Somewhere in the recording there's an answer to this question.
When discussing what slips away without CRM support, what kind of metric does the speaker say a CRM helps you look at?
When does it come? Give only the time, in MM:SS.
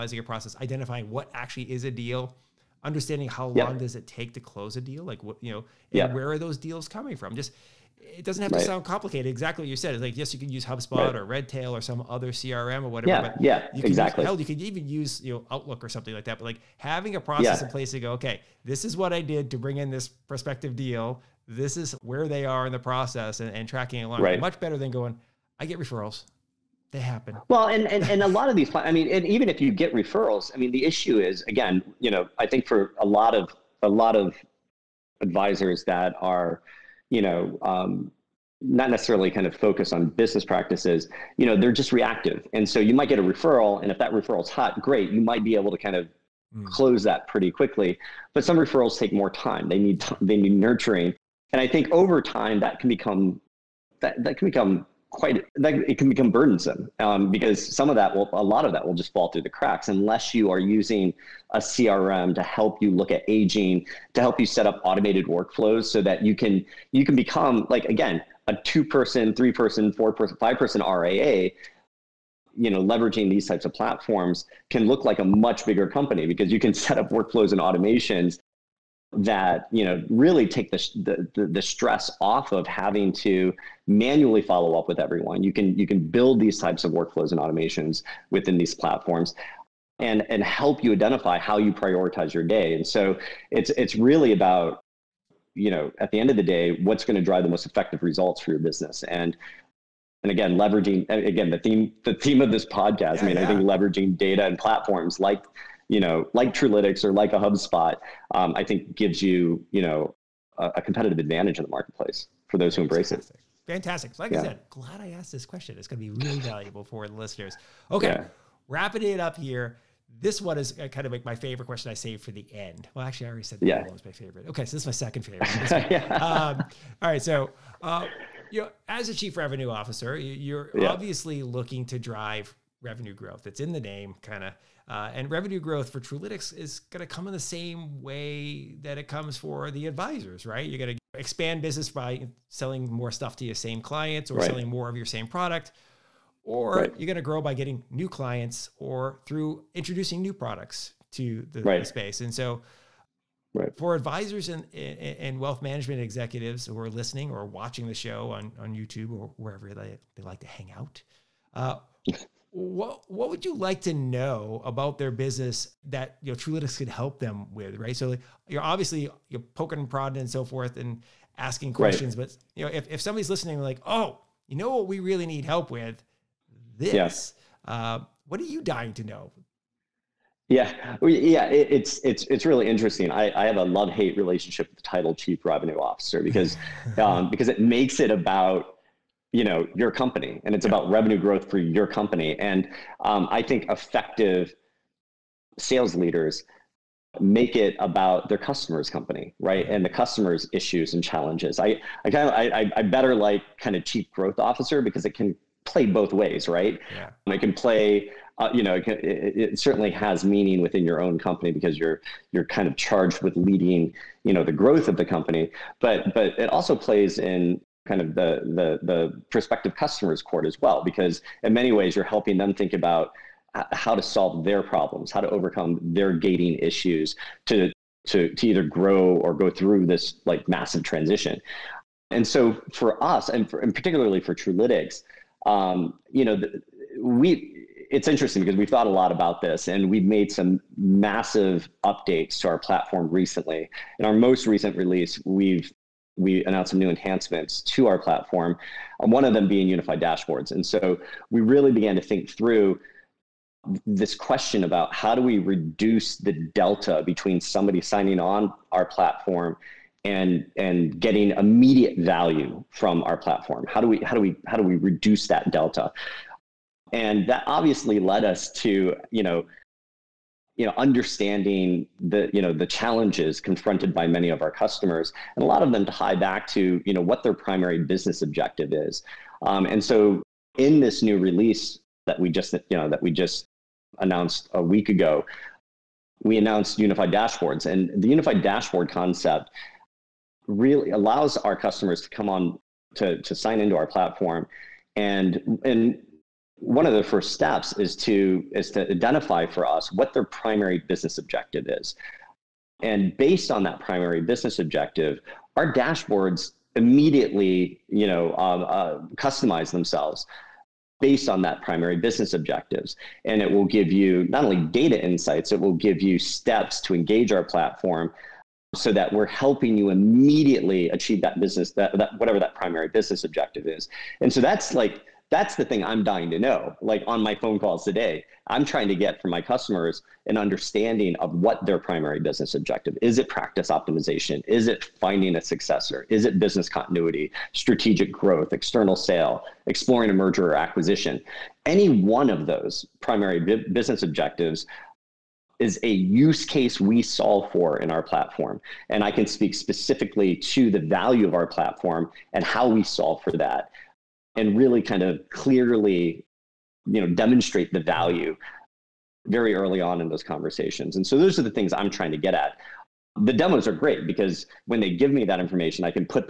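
01:03.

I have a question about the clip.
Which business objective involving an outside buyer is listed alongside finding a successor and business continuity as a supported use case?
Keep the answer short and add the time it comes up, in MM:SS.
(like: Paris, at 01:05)
External sale, at 05:38.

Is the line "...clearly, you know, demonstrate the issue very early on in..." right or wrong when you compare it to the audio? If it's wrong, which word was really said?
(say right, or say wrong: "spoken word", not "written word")
wrong: "value", not "issue".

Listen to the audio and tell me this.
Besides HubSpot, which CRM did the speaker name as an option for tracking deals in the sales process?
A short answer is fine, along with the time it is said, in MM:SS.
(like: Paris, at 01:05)
Redtail, at 00:11.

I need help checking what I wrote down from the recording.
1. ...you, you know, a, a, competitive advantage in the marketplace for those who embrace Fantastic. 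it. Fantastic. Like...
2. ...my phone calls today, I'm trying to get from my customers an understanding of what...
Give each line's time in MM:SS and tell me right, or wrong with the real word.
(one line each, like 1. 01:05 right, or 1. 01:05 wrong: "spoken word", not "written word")
1. 01:49 right
2. 05:27 right.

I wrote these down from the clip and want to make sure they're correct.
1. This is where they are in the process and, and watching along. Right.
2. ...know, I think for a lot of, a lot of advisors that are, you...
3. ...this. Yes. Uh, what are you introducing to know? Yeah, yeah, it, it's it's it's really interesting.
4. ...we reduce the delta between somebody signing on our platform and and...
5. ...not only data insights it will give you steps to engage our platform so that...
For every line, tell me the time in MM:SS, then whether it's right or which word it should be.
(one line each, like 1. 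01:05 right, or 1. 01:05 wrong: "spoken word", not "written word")
1. 00:21 wrong: "tracking", not "watching"
2. 00:32 right
3. 02:56 wrong: "dying", not "introducing"
4. 04:15 right
5. 05:14 right.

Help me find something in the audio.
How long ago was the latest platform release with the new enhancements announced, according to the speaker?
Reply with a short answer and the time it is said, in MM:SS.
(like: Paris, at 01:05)
A week ago, at 04:44.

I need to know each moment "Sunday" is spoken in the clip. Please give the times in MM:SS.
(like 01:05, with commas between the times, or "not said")
not said.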